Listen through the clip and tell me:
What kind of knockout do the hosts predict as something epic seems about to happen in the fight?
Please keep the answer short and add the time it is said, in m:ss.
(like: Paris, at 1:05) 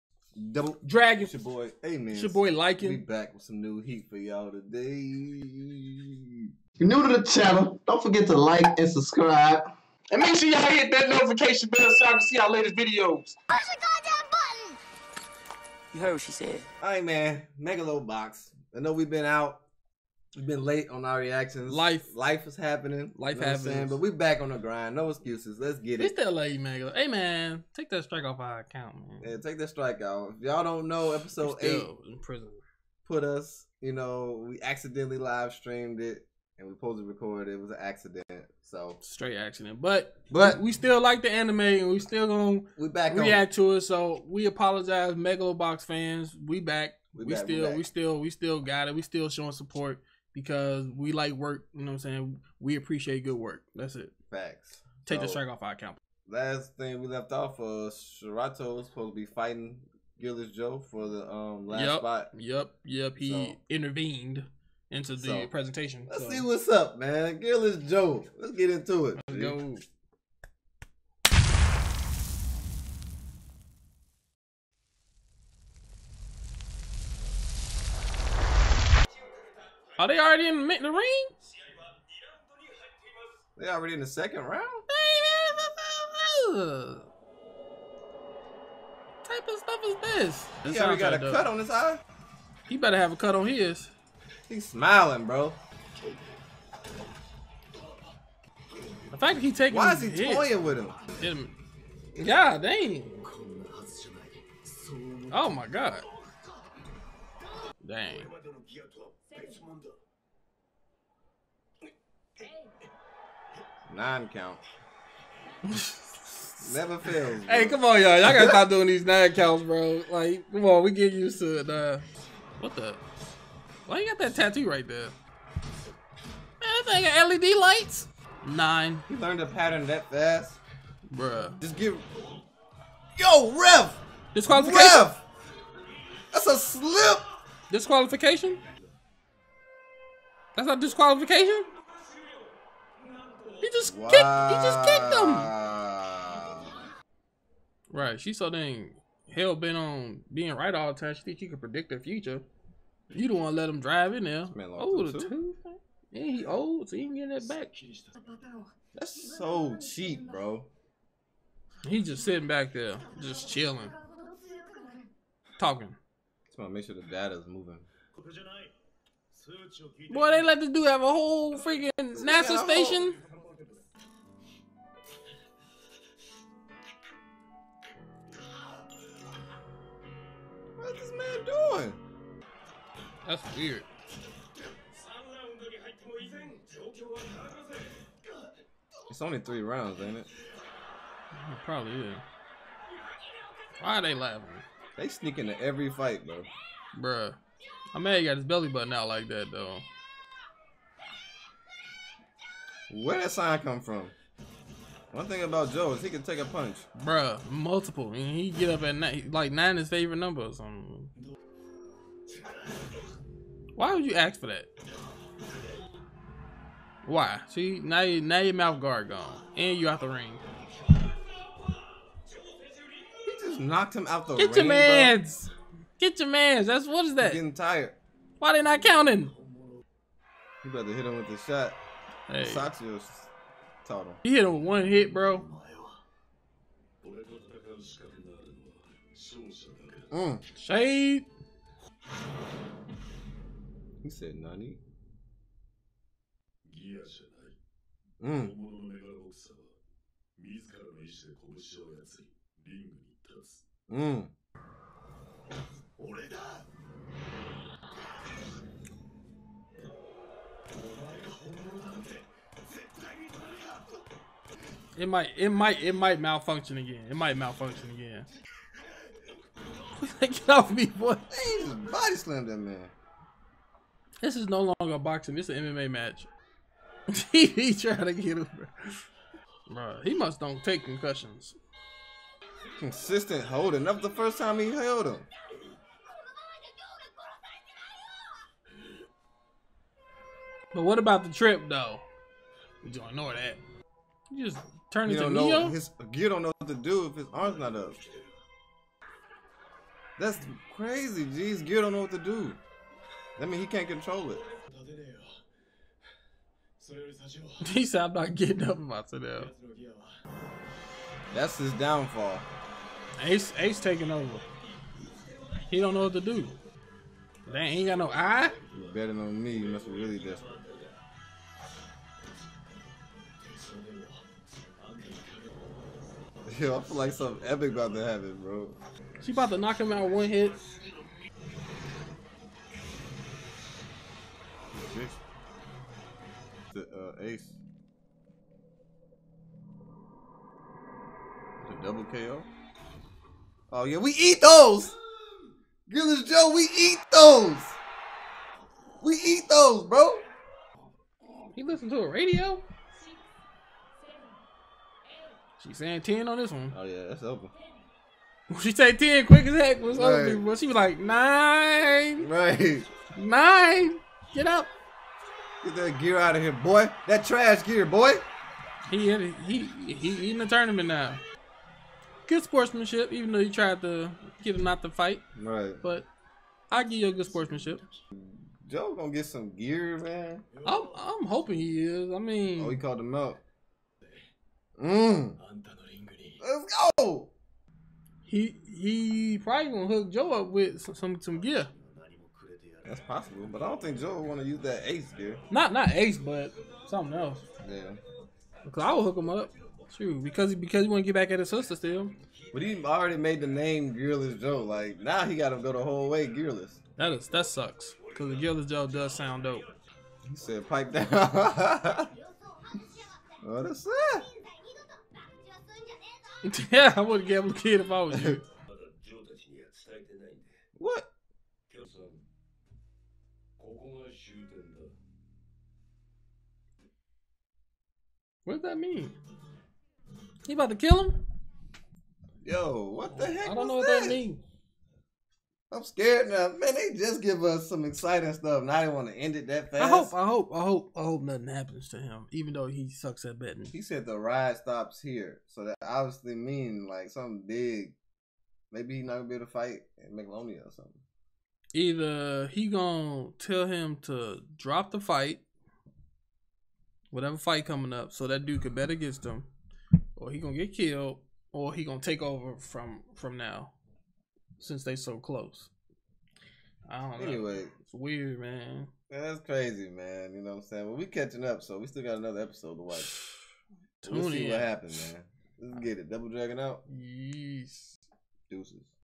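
Double KO, at 5:41.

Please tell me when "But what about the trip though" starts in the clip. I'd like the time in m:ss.
4:50.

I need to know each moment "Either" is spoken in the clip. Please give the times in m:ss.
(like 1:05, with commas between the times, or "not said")
7:31.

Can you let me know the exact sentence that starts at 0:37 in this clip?
It was an accident, so straight accident.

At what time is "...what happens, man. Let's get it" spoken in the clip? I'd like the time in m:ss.
7:54.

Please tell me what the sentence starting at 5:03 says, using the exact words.
That means he can't control it.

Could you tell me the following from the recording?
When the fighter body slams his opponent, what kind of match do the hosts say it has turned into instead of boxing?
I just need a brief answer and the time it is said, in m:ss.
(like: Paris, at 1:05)
MMA, at 4:35.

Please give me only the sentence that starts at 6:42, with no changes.
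But he already made the name Gearless Joe.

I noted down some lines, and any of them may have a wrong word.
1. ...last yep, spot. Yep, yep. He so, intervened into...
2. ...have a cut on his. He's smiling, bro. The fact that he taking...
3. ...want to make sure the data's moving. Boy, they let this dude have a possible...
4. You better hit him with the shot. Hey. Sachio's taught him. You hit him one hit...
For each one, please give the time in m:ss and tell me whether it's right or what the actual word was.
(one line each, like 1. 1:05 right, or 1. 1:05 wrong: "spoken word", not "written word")
1. 1:01 right
2. 1:32 right
3. 2:46 wrong: "whole", not "possible"
4. 3:50 right.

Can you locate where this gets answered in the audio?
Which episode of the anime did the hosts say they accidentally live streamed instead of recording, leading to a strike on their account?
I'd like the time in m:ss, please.
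0:31.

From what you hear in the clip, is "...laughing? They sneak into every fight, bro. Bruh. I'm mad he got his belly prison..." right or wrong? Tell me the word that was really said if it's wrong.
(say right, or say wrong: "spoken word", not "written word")
wrong: "button", not "prison".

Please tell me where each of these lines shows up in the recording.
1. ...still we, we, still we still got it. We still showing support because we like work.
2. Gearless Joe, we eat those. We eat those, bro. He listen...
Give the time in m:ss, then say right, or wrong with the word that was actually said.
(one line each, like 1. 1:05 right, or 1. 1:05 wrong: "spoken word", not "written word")
1. 0:47 right
2. 5:45 right.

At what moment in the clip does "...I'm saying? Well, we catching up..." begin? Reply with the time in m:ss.
7:50.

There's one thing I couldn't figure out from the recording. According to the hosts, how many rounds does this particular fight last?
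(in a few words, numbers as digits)
3.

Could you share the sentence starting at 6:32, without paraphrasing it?
That's possible, but I don't think Joe want to use that ace gear.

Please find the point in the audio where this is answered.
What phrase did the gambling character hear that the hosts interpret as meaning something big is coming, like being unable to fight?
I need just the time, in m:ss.
7:24.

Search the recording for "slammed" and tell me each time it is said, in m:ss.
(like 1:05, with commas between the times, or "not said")
4:32.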